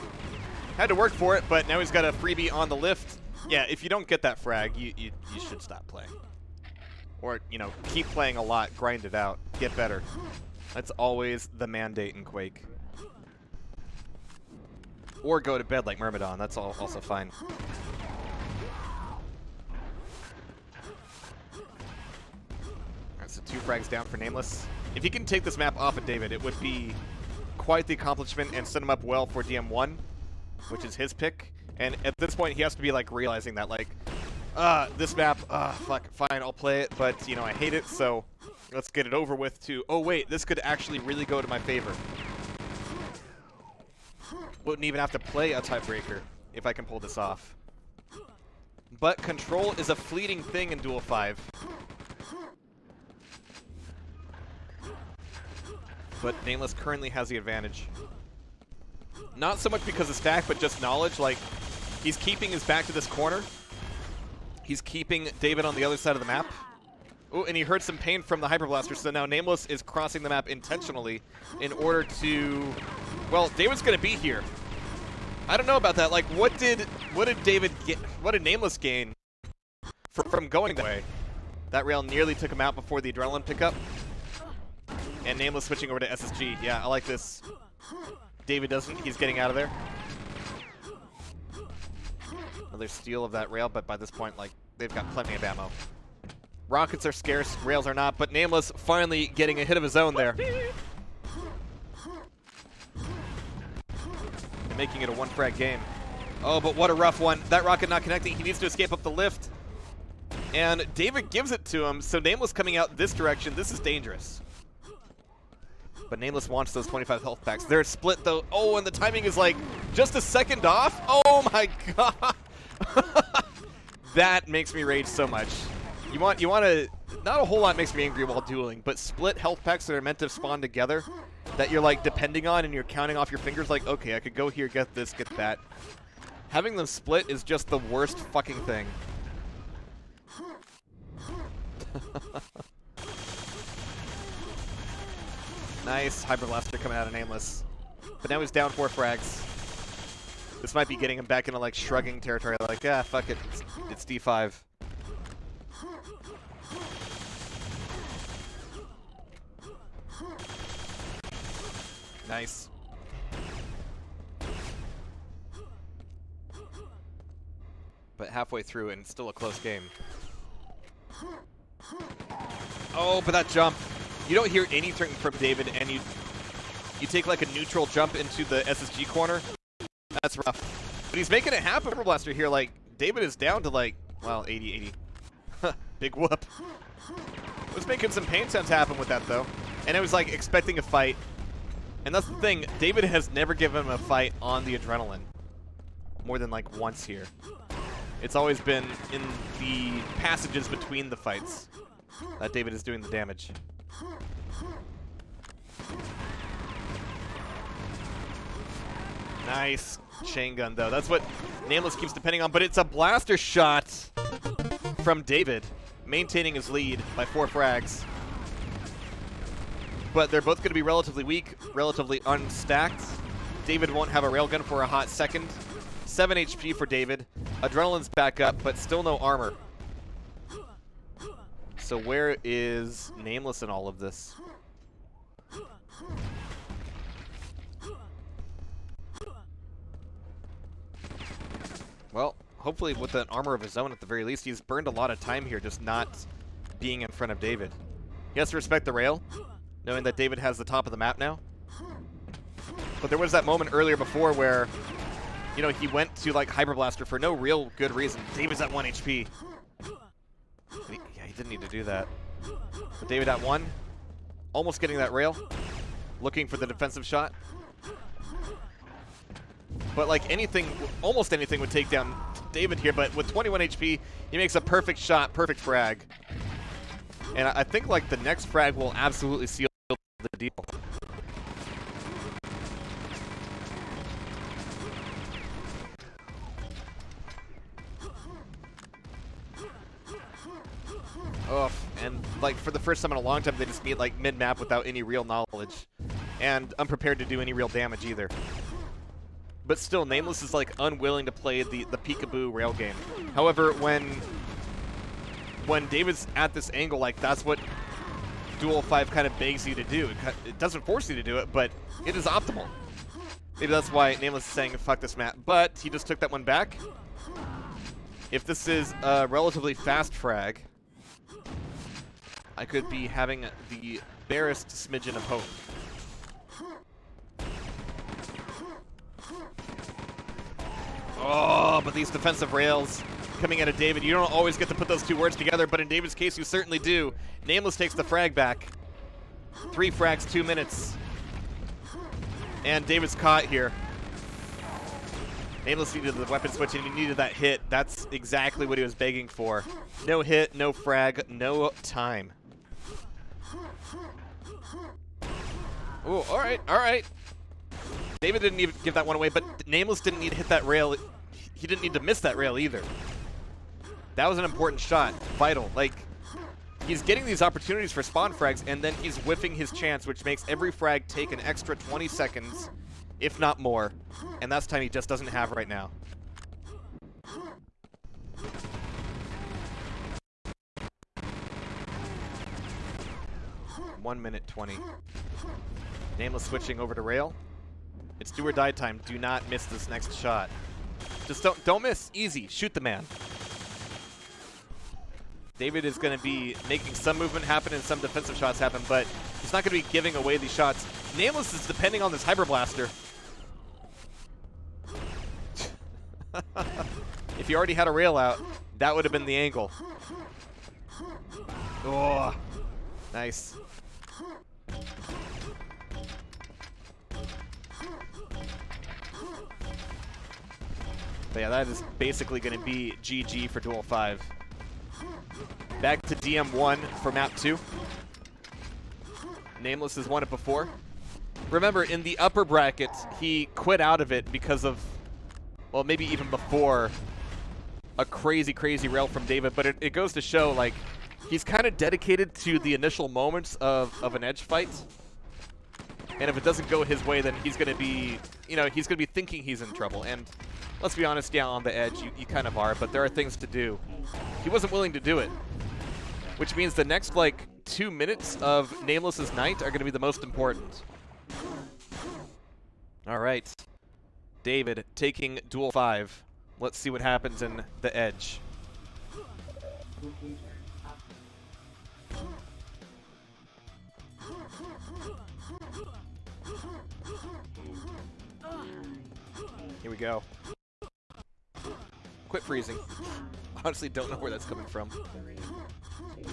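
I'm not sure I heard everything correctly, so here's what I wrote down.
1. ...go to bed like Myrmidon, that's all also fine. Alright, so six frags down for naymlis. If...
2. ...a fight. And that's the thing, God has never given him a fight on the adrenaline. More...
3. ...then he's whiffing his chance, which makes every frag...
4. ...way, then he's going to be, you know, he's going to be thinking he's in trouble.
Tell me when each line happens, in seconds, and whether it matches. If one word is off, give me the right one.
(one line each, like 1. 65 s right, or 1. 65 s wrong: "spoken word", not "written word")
1. 15 s wrong: "two", not "six"
2. 190 s wrong: "David", not "God"
3. 368 s right
4. 447 s right.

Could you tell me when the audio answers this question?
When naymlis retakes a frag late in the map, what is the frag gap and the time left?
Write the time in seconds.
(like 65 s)
339 s.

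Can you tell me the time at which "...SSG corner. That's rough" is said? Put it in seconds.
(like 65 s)
178 s.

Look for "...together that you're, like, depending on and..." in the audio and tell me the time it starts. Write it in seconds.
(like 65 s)
130 s.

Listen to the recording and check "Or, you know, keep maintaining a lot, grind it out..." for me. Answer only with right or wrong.
wrong.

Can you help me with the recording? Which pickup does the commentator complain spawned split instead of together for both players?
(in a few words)
25 health packs.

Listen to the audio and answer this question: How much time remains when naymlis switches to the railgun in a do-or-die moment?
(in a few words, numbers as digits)
1 minute 20.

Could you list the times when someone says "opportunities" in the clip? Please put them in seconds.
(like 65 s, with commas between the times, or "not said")
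367 s.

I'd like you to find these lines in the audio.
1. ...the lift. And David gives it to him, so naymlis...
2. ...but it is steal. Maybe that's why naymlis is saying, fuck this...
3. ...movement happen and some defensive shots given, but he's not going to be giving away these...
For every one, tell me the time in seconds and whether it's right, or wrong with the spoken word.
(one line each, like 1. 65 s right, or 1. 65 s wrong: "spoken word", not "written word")
1. 109 s right
2. 311 s wrong: "optimal", not "steal"
3. 397 s wrong: "happen", not "given".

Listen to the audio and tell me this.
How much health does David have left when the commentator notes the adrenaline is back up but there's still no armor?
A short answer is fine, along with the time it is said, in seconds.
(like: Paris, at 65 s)
7 HP, at 226 s.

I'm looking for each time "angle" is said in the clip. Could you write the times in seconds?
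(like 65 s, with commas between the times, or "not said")
306 s, 409 s.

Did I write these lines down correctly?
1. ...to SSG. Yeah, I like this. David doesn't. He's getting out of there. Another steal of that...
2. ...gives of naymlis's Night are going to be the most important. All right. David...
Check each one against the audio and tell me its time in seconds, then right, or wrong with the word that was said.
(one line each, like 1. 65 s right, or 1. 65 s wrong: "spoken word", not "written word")
1. 86 s right
2. 457 s wrong: "minutes", not "gives".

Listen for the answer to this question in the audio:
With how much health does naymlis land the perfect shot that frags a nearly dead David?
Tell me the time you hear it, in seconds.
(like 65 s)
273 s.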